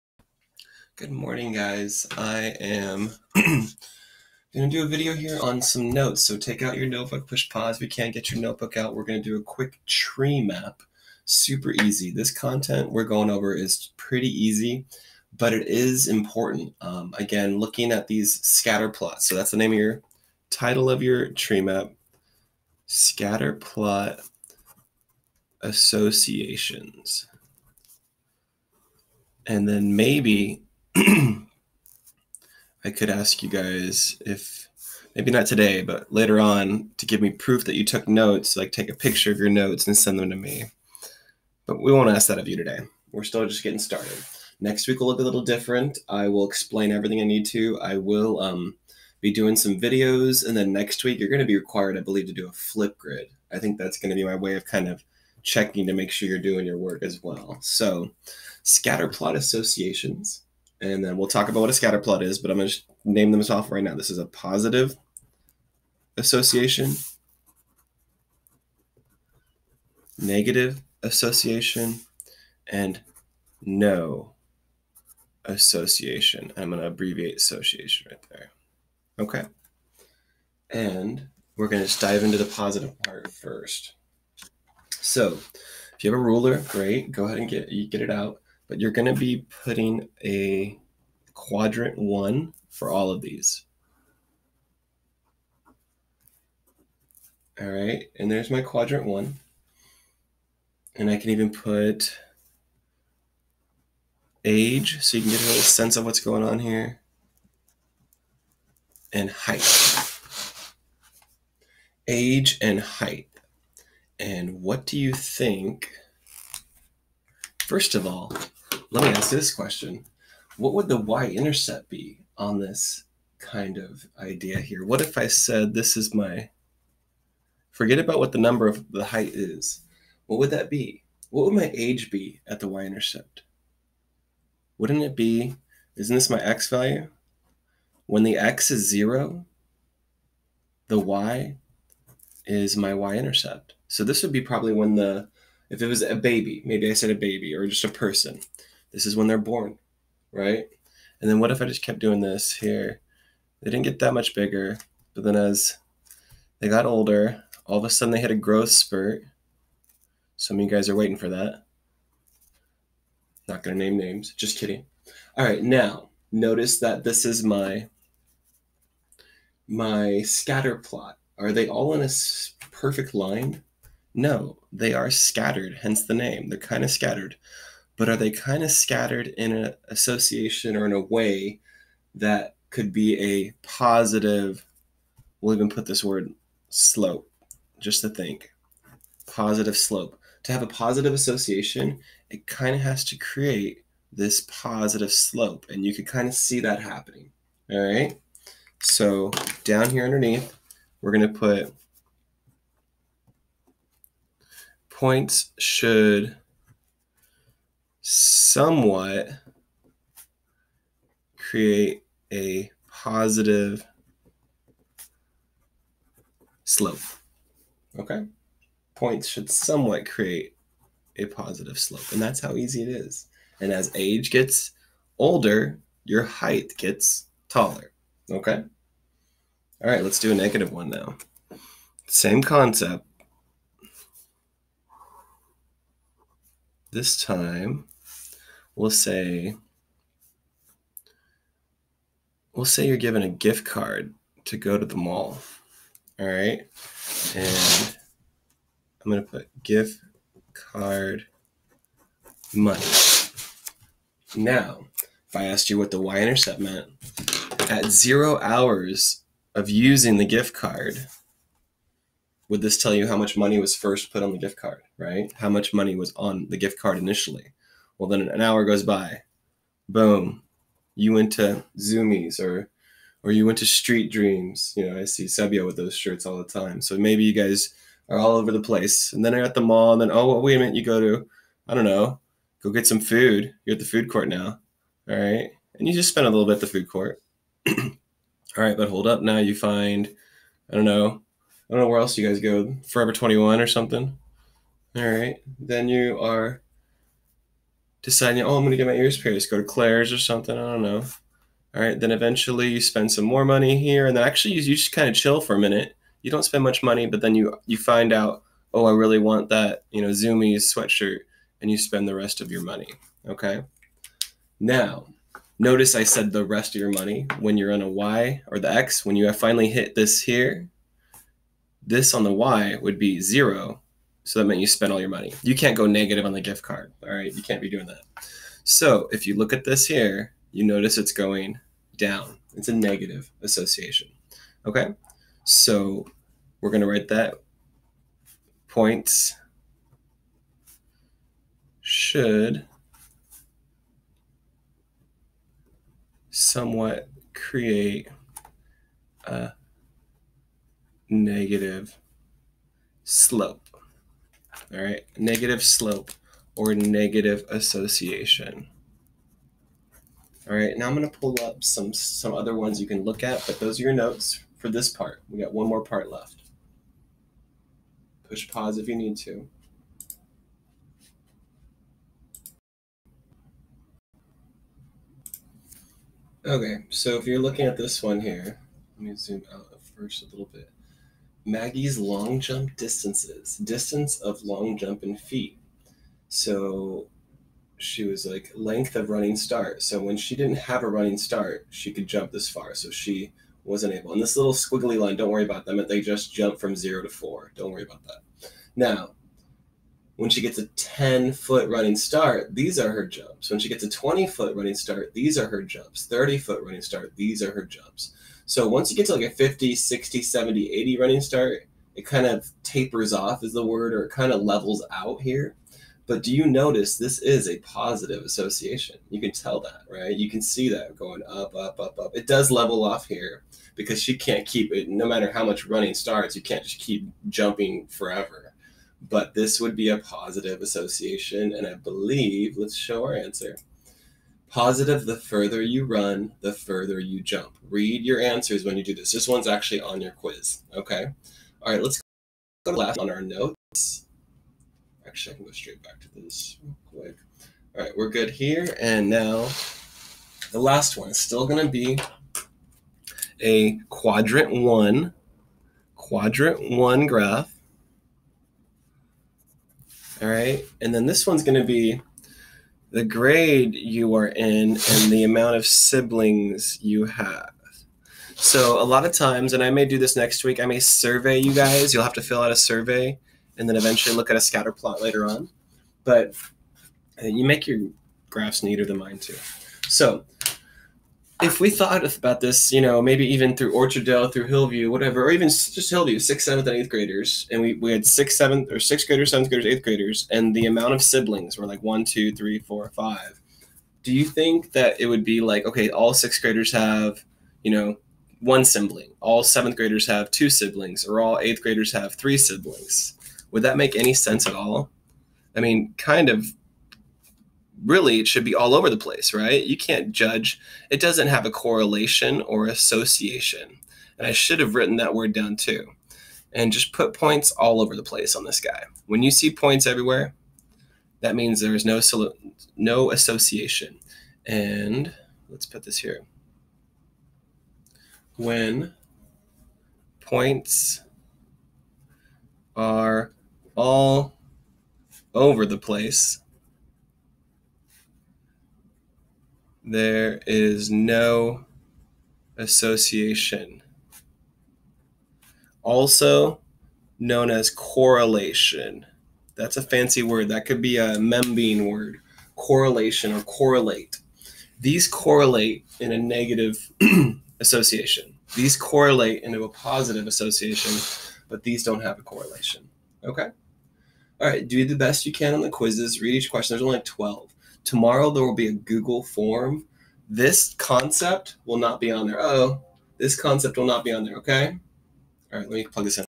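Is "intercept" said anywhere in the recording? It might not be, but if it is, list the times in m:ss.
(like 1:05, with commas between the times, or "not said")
2:00, 2:12, 2:22, 4:16.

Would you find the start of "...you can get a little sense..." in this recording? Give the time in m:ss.
1:45.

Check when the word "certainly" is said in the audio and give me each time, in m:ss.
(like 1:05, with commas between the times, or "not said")
not said.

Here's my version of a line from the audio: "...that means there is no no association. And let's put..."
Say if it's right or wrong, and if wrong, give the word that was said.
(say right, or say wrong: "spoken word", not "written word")
right.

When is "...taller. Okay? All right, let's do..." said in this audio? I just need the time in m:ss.
3:47.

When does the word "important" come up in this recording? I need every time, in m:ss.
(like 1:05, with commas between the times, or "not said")
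0:16.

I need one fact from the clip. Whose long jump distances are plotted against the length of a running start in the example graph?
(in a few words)
Maggie.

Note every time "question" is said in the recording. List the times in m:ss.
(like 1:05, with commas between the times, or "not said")
1:59, 9:26.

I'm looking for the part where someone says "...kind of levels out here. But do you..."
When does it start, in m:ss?
6:54.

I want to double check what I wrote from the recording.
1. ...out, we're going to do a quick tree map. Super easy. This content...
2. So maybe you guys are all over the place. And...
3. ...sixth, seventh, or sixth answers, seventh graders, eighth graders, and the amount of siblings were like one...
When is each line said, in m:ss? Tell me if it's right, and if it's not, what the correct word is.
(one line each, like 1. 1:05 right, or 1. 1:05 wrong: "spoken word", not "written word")
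1. 0:08 right
2. 4:36 right
3. 8:08 wrong: "graders", not "answers".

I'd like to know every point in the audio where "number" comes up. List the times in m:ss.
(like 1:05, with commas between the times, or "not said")
2:08.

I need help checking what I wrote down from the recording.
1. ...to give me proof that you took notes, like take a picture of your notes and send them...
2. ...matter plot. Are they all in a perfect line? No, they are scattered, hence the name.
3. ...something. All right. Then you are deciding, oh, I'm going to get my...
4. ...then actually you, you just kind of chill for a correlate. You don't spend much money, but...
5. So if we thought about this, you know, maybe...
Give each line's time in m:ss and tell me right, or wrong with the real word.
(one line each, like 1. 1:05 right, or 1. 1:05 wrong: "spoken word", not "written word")
1. 0:36 right
2. 2:50 wrong: "scatter", not "matter"
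3. 4:53 right
4. 5:04 wrong: "minute", not "correlate"
5. 7:59 right.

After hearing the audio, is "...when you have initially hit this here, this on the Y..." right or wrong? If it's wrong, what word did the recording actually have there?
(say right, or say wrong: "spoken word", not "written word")
wrong: "finally", not "initially".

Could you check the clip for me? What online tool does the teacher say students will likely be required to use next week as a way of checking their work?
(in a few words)
Flipgrid.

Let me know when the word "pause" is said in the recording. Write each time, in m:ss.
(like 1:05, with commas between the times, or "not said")
0:07, 6:08.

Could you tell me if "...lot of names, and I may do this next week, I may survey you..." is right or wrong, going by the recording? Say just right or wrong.
wrong.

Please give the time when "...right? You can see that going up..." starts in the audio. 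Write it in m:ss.
6:59.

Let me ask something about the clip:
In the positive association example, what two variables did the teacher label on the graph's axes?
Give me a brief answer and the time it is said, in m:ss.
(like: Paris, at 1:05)
age and height, at 1:52.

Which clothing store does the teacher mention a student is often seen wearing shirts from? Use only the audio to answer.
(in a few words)
Street Dreams.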